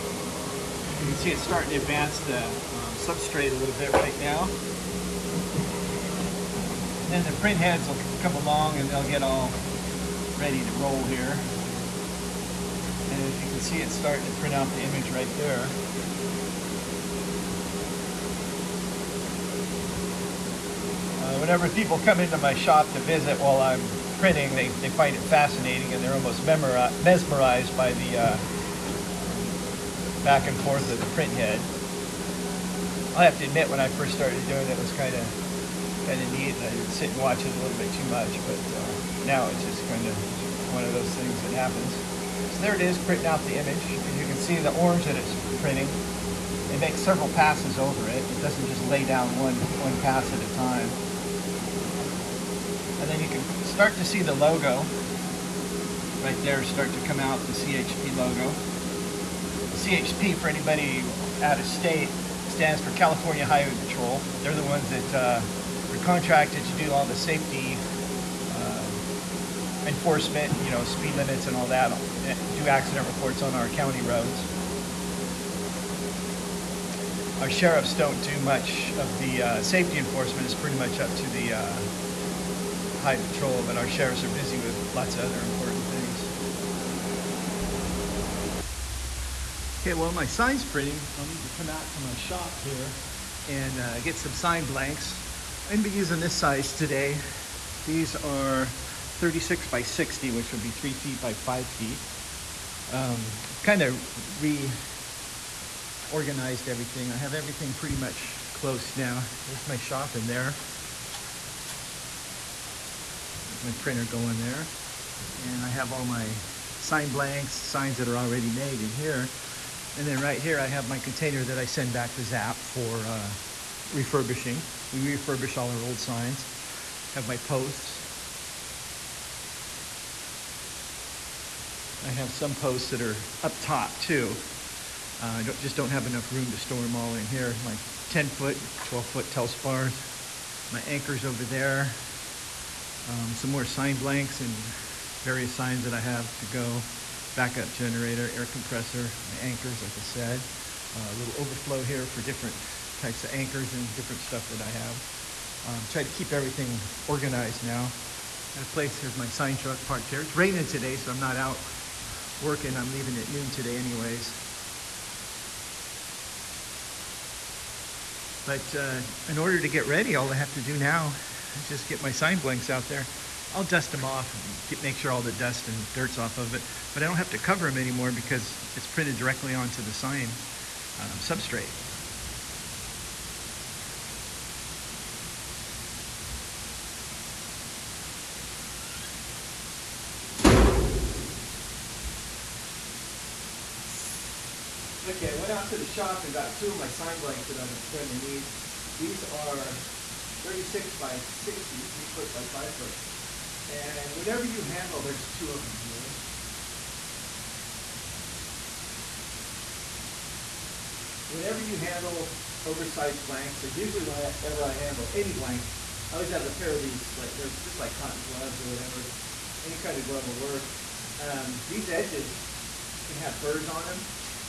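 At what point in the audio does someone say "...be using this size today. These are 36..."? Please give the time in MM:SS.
01:35.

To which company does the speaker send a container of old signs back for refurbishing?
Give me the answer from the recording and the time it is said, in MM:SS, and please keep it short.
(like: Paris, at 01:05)
Zap, at 02:02.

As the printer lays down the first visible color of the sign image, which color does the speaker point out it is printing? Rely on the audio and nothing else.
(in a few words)
Orange.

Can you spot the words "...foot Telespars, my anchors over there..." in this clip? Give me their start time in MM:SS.
02:19.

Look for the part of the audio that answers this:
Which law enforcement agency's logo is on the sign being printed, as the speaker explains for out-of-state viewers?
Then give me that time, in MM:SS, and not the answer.
01:02.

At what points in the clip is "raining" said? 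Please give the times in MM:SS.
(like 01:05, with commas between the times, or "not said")
02:40.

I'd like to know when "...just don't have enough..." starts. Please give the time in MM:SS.
02:15.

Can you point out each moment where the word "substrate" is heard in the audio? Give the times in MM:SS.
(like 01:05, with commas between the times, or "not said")
00:02, 03:01.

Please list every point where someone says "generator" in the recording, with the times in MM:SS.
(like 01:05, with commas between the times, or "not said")
02:27.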